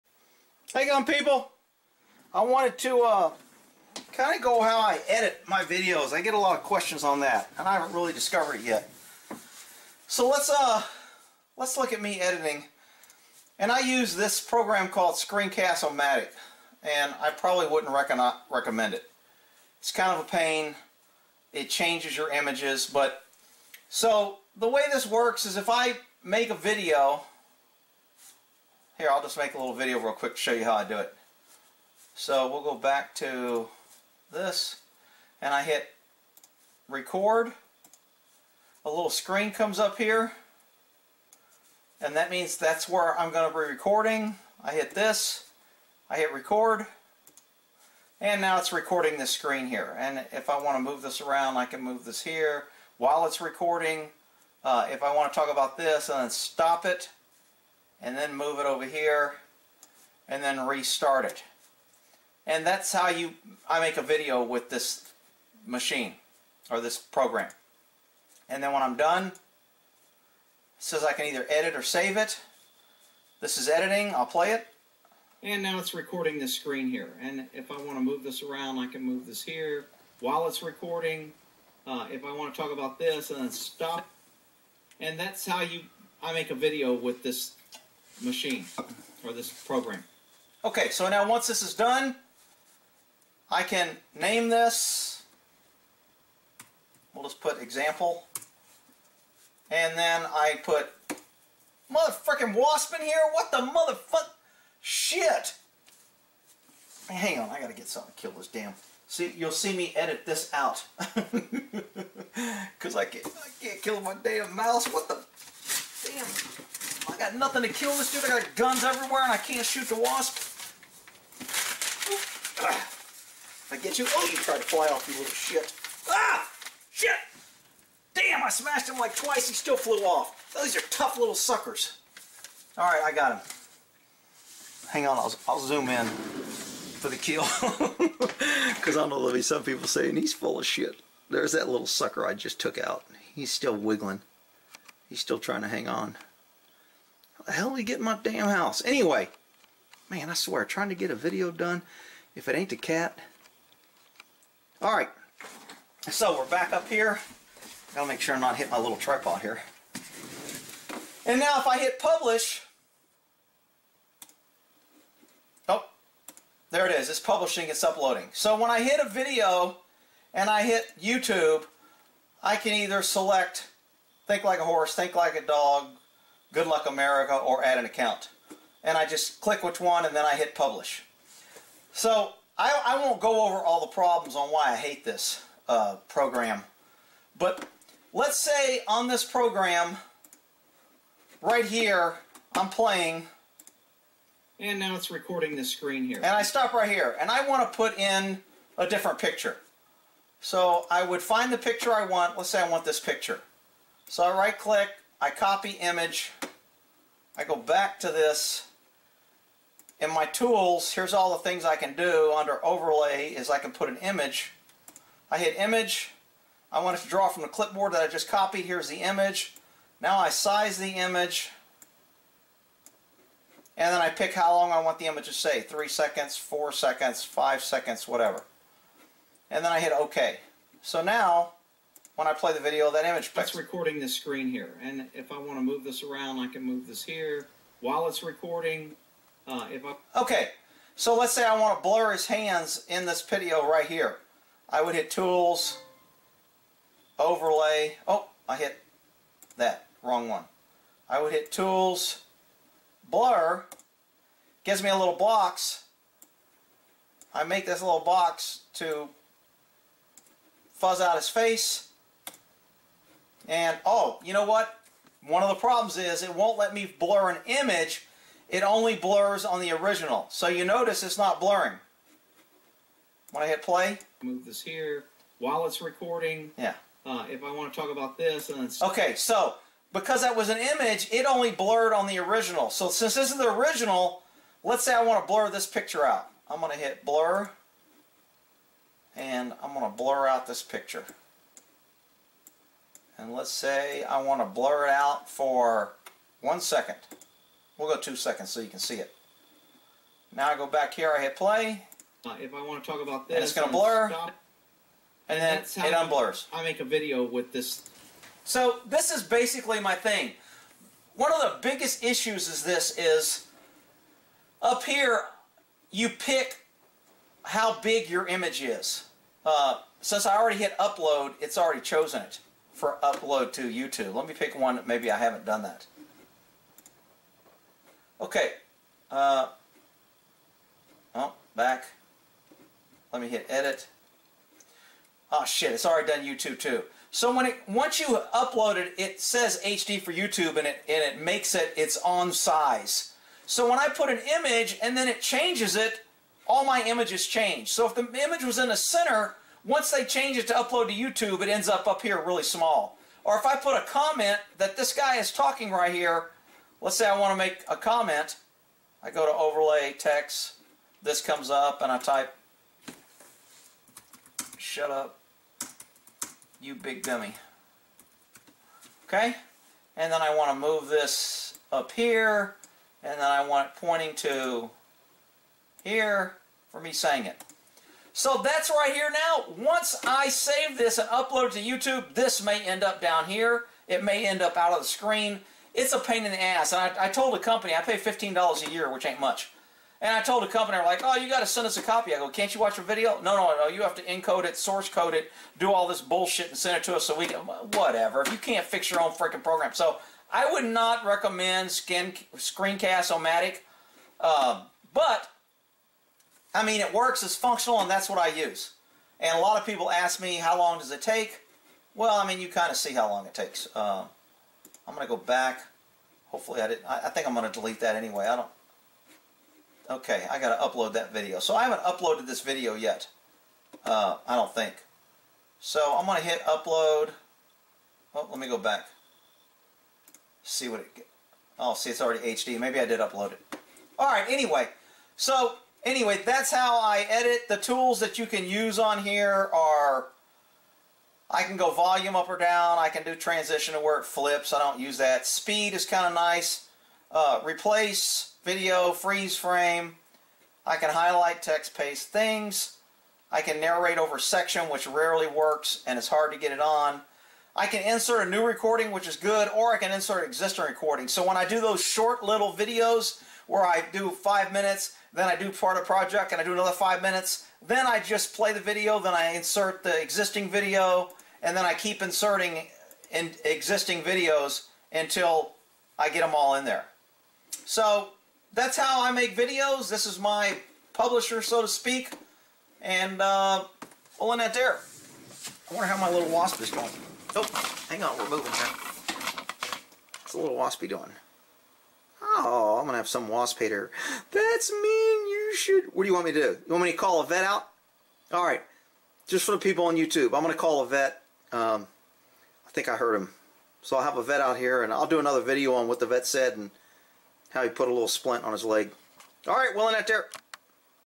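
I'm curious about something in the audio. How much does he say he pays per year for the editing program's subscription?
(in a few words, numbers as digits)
$15.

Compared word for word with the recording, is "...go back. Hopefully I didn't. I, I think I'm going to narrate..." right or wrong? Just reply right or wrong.
wrong.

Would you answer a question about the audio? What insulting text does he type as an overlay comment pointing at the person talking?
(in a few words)
Shut up, you big dummy.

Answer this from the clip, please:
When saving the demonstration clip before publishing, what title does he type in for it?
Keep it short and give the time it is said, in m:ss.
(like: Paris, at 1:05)
example, at 1:37.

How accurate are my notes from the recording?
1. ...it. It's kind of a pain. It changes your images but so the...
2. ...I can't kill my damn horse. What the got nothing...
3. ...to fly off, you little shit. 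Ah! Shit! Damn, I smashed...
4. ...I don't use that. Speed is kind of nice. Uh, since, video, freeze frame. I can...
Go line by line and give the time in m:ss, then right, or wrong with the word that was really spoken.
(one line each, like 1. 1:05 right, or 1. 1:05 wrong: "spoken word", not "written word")
1. 0:18 right
2. 1:53 wrong: "mouse", not "horse"
3. 2:04 right
4. 7:24 wrong: "replace", not "since".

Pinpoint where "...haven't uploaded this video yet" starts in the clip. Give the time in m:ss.
7:01.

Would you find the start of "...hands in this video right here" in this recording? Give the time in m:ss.
4:02.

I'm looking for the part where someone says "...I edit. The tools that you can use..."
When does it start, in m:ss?
7:16.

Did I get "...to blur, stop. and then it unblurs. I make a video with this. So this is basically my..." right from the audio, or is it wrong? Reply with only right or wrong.
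right.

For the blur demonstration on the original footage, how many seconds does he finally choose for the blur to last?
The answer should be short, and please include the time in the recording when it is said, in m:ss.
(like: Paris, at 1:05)
2 seconds, at 4:57.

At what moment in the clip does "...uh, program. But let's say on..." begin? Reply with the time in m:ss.
3:05.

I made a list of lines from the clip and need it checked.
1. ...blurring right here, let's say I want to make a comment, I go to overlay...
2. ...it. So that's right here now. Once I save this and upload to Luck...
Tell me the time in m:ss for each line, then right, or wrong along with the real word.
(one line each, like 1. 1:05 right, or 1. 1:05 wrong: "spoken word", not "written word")
1. 5:55 wrong: "talking", not "blurring"
2. 6:17 wrong: "YouTube", not "Luck".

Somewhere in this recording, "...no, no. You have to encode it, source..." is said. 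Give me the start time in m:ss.
6:33.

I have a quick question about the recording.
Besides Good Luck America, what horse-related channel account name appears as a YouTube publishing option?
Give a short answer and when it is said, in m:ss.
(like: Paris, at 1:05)
Think like a horse, at 2:54.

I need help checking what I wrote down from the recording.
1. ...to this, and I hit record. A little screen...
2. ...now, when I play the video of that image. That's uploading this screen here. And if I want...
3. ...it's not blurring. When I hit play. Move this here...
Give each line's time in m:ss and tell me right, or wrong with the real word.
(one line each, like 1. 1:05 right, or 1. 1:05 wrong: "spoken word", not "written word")
1. 0:33 right
2. 3:51 wrong: "recording", not "uploading"
3. 4:31 right.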